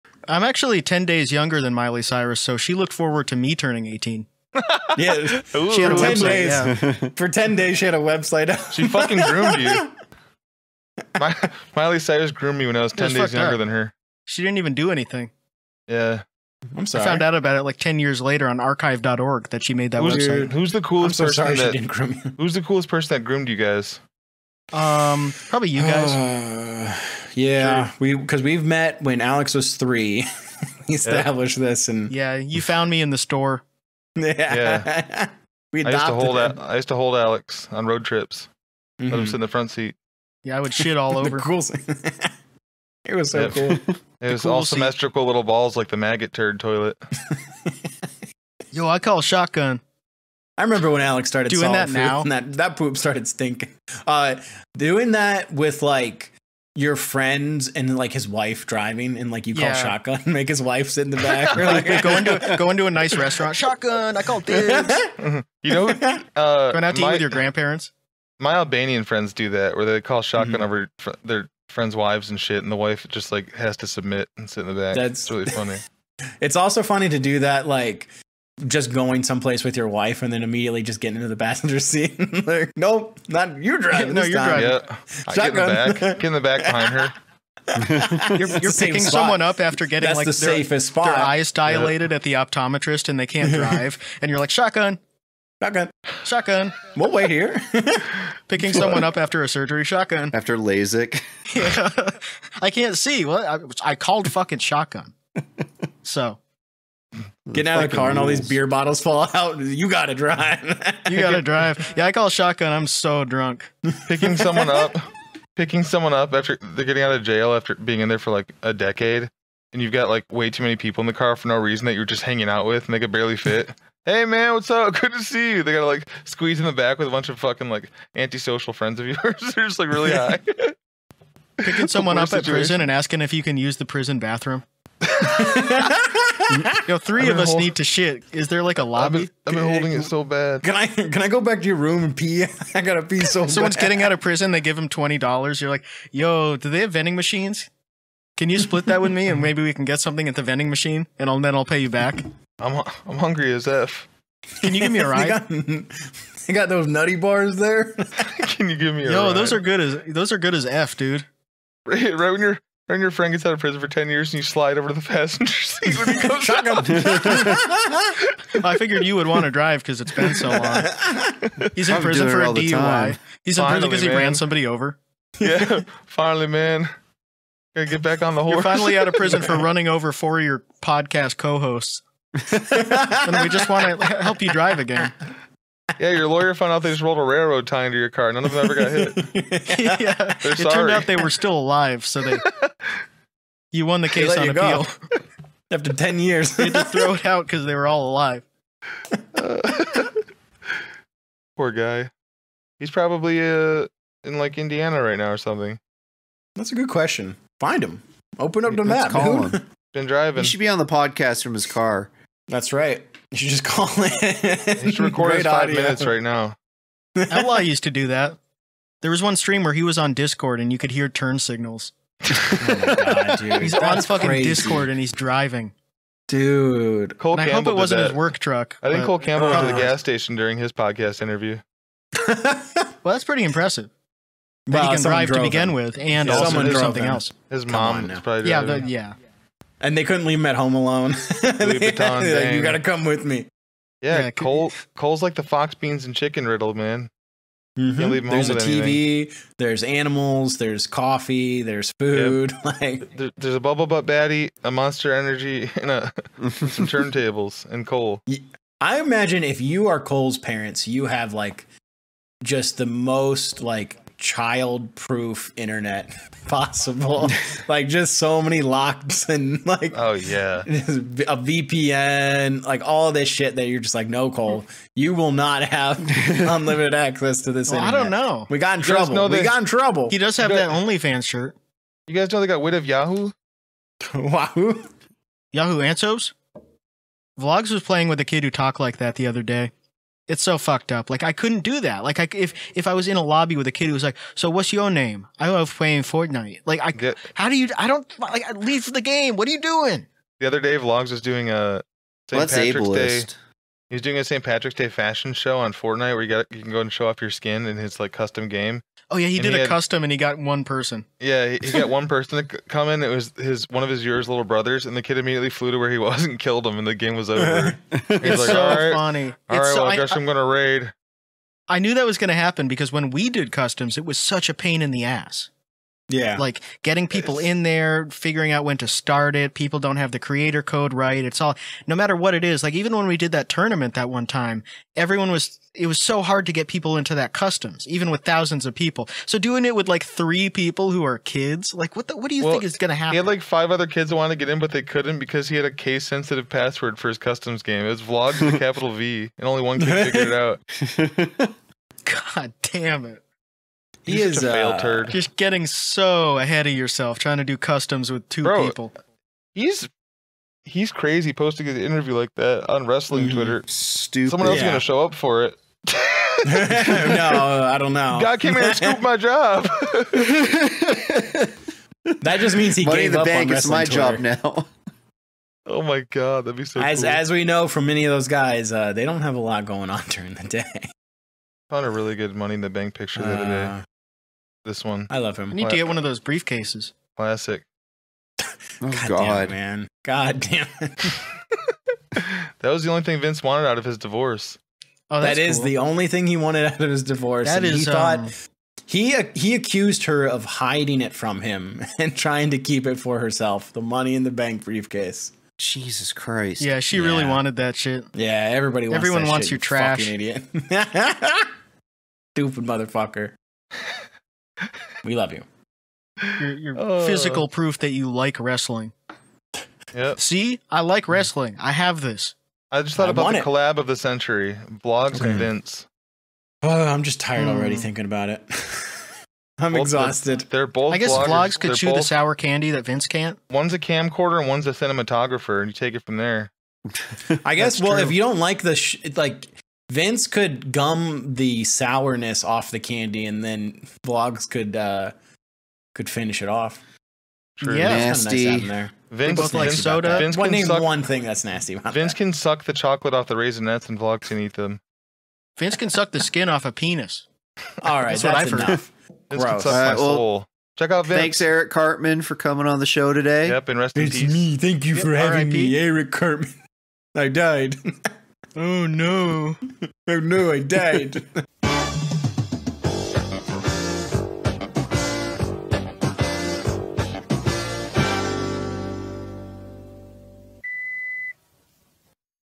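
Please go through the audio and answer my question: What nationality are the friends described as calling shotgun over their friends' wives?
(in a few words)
Albanian.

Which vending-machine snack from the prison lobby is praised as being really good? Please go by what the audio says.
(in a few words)
Nutty bars.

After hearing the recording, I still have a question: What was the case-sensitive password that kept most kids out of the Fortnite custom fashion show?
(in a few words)
vlogged.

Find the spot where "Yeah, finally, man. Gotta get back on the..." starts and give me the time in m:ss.
2:55.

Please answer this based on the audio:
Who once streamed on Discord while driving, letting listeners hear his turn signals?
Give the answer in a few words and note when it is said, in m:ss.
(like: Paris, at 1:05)
Outlaw, at 3:37.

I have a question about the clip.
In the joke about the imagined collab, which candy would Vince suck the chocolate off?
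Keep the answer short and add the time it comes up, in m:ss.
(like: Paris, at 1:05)
Raisinets, at 7:33.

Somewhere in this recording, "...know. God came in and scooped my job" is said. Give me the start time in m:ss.
6:07.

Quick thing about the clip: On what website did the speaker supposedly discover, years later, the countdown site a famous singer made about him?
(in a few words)
archive.org.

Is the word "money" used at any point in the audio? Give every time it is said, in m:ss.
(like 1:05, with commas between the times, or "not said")
6:12, 6:22, 6:43.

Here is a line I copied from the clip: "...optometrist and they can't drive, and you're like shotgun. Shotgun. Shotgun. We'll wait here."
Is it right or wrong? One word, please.
right.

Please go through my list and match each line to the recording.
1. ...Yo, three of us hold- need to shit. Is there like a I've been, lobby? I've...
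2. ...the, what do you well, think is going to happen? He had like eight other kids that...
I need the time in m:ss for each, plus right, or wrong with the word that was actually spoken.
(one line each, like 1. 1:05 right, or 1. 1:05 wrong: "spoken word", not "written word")
1. 2:16 right
2. 5:42 wrong: "five", not "eight".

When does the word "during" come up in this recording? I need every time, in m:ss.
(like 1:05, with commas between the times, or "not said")
3:50, 6:20.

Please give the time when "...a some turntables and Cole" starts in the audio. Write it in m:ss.
4:15.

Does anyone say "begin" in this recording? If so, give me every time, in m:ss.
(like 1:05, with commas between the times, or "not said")
3:55.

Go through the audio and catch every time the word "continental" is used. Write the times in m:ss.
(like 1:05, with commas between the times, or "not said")
not said.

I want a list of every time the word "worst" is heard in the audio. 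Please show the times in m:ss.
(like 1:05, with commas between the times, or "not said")
not said.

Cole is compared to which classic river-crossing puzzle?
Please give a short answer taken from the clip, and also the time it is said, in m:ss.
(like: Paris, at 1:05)
The fox, beans and chicken riddle, at 4:05.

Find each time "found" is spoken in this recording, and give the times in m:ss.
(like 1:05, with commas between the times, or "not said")
0:17, 0:32, 3:06, 6:21.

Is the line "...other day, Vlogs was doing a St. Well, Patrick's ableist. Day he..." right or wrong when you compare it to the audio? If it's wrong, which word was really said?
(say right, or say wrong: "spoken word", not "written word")
right.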